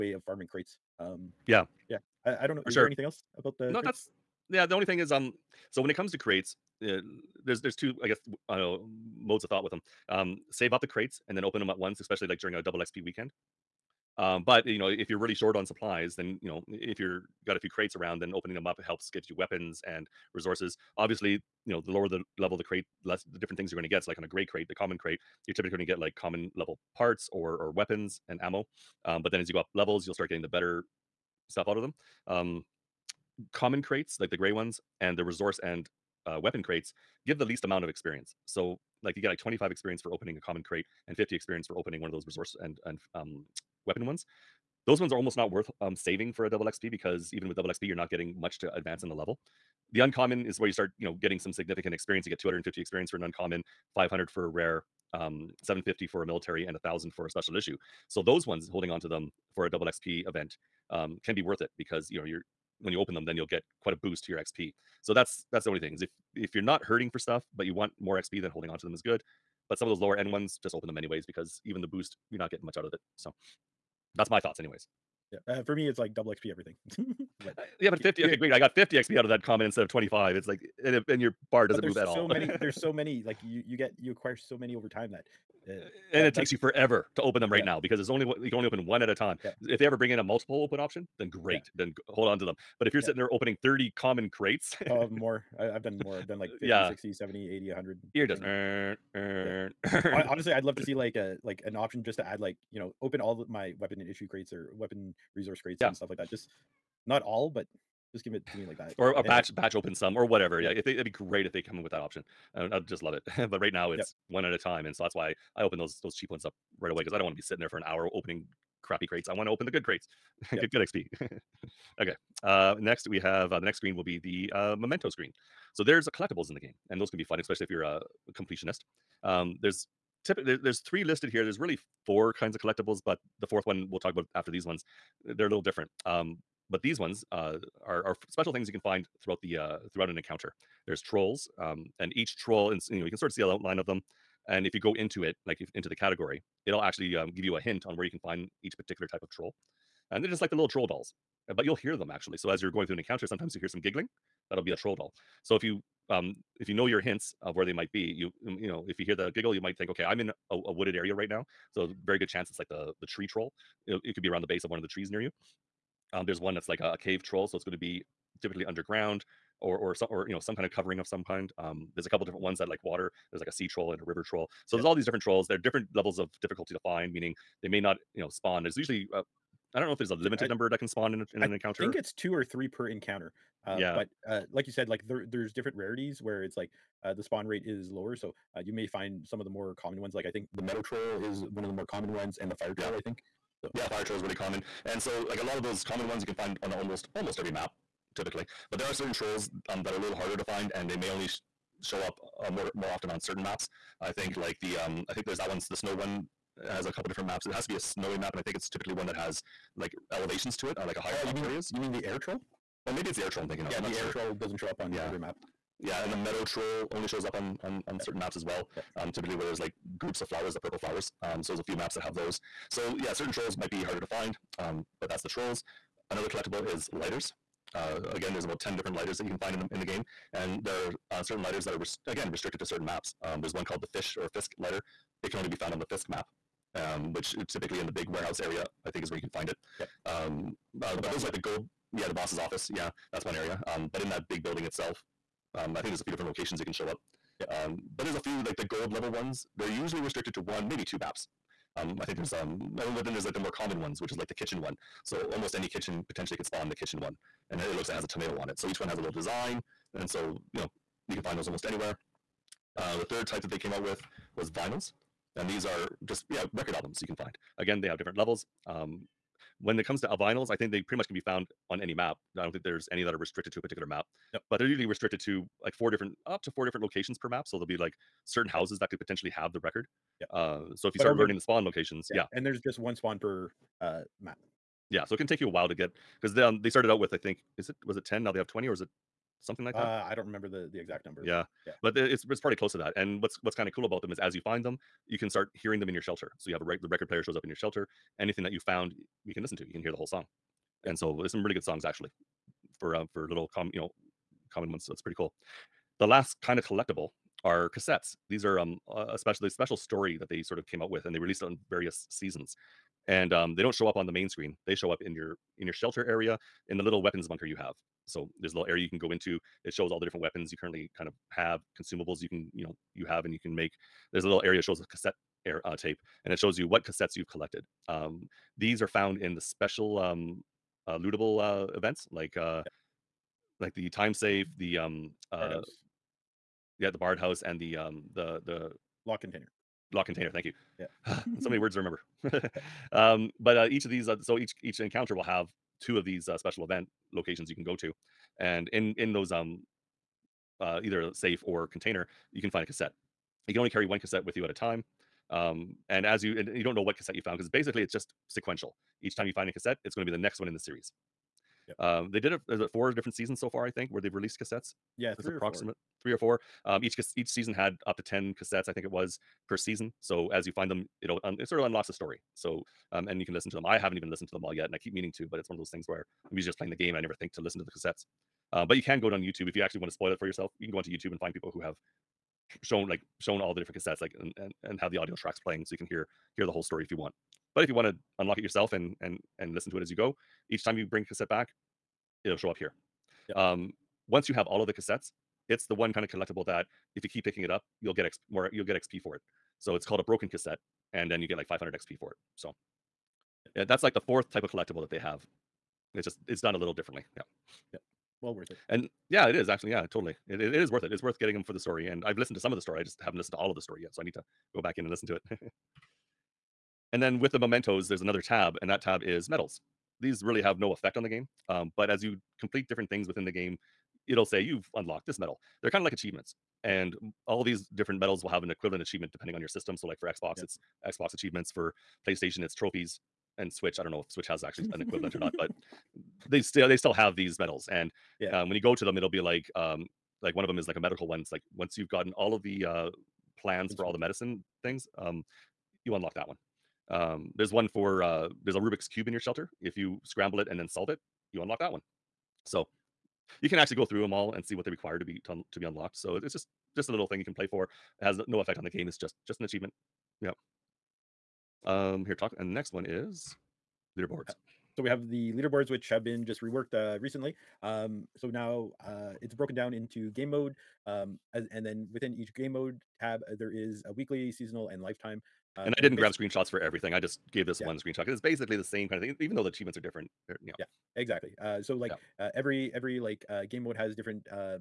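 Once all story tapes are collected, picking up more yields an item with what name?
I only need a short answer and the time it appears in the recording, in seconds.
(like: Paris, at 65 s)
broken cassette, at 400 s.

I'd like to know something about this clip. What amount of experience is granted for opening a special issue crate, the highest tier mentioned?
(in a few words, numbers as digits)
1000.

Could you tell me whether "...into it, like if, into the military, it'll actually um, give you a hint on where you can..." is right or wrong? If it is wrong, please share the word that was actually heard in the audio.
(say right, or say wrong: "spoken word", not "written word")
wrong: "category", not "military".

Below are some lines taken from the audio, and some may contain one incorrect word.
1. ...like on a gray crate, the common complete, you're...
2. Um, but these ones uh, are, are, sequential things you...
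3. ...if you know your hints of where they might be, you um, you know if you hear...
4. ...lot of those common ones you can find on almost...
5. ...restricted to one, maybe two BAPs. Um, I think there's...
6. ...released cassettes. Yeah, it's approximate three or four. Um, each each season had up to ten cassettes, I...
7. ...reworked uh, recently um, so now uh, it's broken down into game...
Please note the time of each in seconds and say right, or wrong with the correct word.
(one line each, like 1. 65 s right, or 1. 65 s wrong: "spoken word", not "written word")
1. 24 s wrong: "crate", not "complete"
2. 136 s wrong: "special", not "sequential"
3. 156 s right
4. 195 s right
5. 249 s right
6. 364 s right
7. 466 s right.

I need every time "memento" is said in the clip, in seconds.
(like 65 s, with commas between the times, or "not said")
124 s, 417 s.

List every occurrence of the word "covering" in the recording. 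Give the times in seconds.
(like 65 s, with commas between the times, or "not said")
170 s.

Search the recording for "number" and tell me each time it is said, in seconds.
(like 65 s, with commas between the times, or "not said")
180 s, 291 s.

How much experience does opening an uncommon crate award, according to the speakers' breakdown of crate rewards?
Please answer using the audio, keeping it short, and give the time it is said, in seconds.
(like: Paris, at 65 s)
250, at 52 s.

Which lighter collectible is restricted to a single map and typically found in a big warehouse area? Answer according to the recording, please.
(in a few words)
Fisk lighter.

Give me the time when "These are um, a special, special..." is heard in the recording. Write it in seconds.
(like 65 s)
308 s.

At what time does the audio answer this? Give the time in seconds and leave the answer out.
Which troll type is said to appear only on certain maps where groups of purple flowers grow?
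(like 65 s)
216 s.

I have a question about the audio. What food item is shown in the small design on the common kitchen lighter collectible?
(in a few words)
tomato.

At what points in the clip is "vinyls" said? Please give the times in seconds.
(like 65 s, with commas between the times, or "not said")
264 s, 270 s.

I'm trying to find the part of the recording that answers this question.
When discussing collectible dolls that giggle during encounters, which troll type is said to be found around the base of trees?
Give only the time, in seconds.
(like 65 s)
163 s.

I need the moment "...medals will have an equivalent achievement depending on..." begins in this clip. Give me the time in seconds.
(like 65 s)
427 s.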